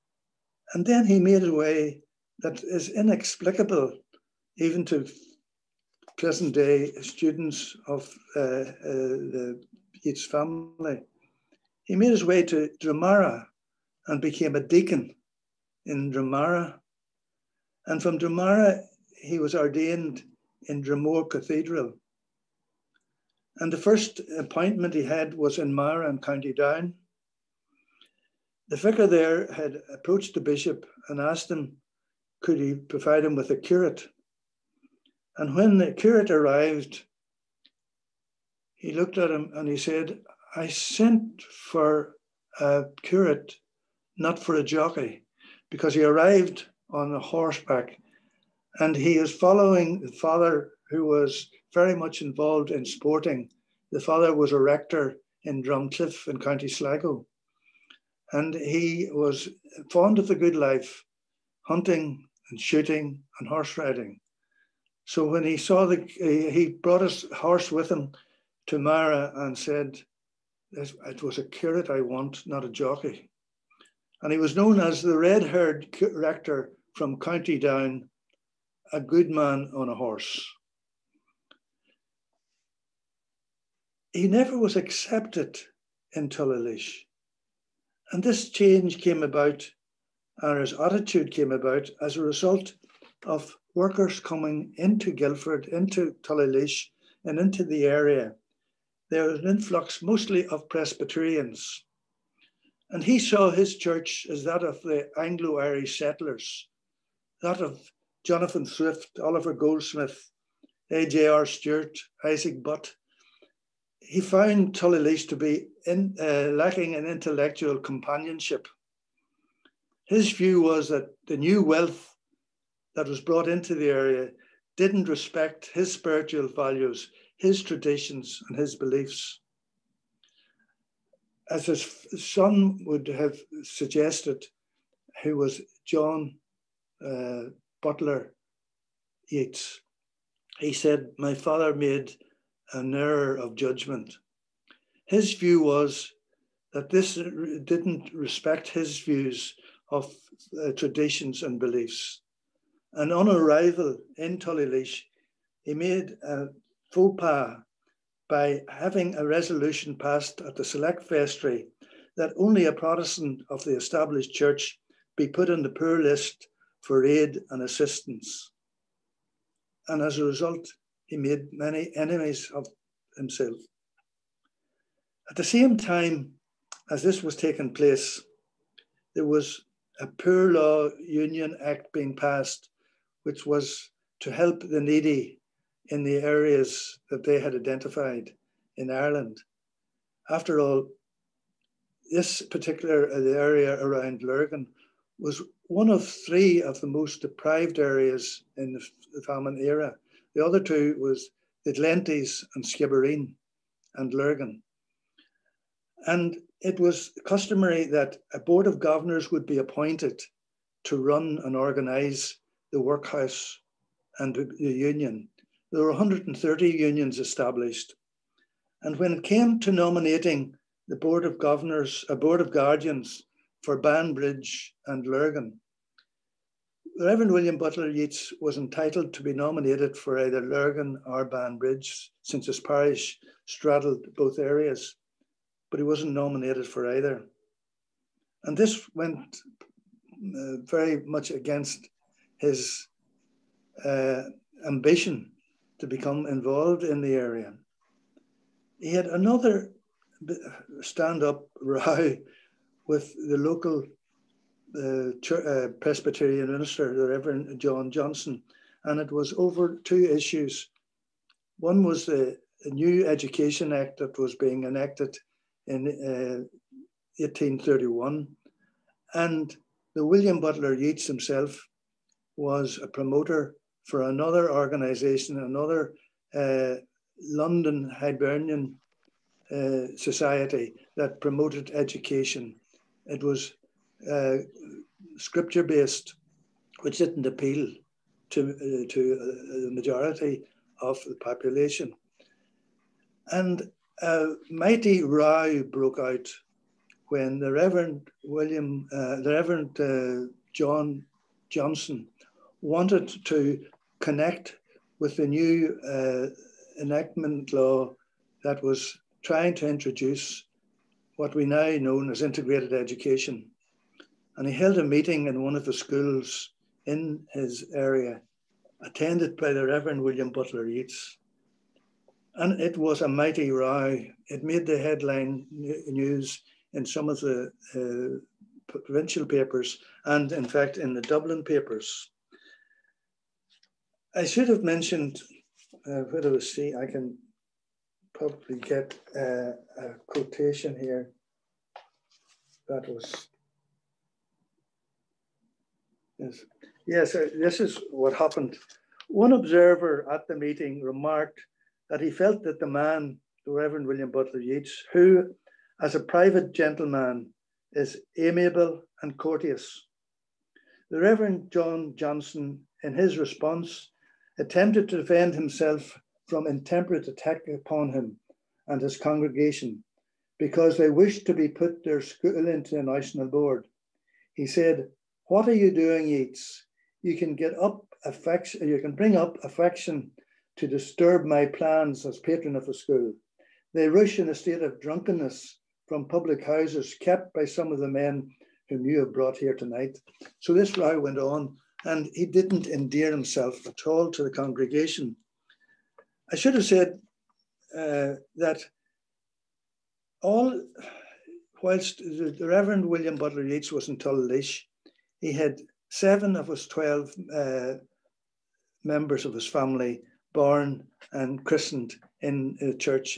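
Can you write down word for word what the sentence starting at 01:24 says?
He never was accepted in Tullylish.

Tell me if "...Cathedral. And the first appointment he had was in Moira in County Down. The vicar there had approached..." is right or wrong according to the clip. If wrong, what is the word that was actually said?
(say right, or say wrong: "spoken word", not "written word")
right.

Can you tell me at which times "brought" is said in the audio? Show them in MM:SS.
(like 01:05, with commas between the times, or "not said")
01:06, 02:03, 06:29.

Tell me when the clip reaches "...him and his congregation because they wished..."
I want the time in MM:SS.
06:07.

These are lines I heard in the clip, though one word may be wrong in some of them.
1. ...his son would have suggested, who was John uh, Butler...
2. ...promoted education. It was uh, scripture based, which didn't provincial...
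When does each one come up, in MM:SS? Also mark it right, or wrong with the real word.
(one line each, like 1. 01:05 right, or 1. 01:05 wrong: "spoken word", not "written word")
1. 02:11 right
2. 04:41 wrong: "appeal", not "provincial".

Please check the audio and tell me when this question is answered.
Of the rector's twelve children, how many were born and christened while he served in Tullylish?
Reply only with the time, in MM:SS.
06:45.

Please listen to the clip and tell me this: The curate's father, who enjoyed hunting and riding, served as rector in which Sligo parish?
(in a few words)
Drumcliff.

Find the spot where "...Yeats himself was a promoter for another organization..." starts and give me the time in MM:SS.
04:30.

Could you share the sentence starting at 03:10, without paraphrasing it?
After all, this particular area around Lurgan was one of three of the most deprived areas in the, the famine era.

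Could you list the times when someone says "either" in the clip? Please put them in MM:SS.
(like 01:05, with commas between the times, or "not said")
03:50, 03:56.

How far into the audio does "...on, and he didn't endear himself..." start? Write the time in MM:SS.
06:31.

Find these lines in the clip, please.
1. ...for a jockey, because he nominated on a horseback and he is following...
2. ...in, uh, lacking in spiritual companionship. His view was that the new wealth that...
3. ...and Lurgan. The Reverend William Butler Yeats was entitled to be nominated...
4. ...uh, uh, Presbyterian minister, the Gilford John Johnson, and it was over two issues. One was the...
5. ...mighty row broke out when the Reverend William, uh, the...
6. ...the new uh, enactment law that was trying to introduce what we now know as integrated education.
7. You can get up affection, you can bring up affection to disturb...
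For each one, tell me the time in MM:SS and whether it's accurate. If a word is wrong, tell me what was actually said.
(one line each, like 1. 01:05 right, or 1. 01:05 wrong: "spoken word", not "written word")
1. 00:44 wrong: "arrived", not "nominated"
2. 01:55 wrong: "intellectual", not "spiritual"
3. 03:44 right
4. 04:14 wrong: "Reverend", not "Gilford"
5. 04:54 right
6. 05:05 right
7. 06:17 right.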